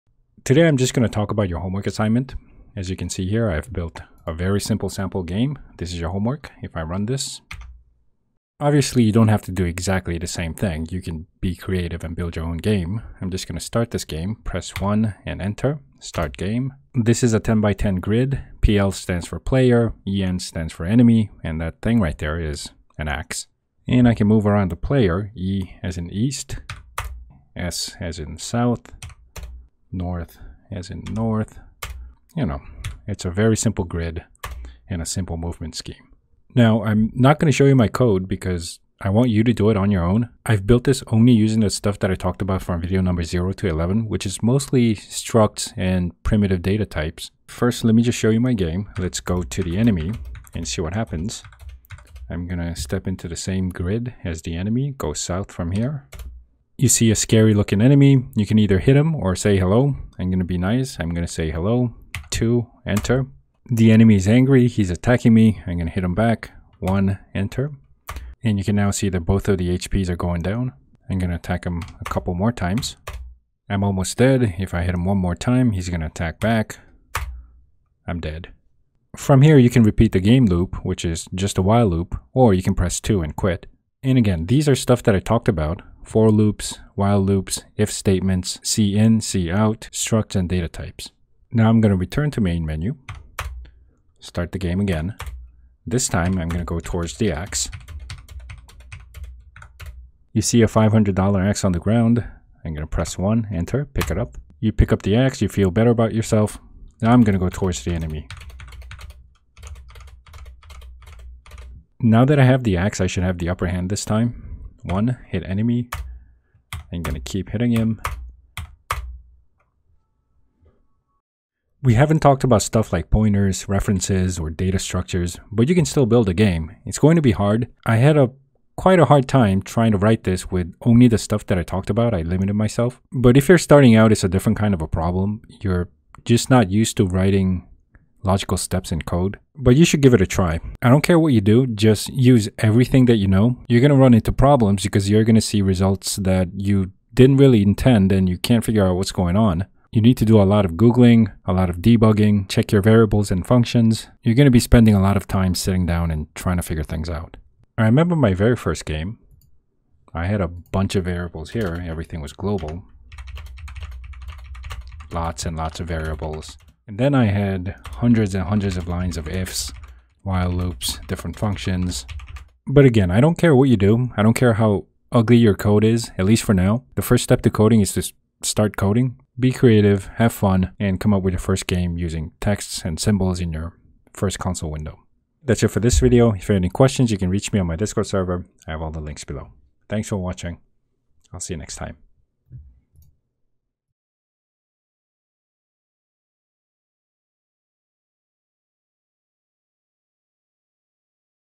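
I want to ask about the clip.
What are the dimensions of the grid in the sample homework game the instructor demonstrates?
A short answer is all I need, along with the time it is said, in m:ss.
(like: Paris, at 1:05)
10 by 10, at 0:17.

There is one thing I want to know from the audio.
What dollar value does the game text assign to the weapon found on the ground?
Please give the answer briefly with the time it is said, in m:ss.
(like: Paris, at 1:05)
$500, at 1:40.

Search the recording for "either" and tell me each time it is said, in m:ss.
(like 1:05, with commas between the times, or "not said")
0:58.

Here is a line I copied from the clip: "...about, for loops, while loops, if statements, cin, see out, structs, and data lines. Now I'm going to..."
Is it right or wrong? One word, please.
wrong.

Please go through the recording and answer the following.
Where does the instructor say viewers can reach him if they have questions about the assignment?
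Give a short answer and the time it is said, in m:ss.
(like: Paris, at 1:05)
Discord server, at 3:07.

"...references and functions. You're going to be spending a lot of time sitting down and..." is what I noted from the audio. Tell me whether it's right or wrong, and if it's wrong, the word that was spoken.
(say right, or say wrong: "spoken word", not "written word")
wrong: "variables", not "references".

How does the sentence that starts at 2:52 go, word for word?
But again, I don't care what you do.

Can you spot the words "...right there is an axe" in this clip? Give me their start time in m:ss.
0:22.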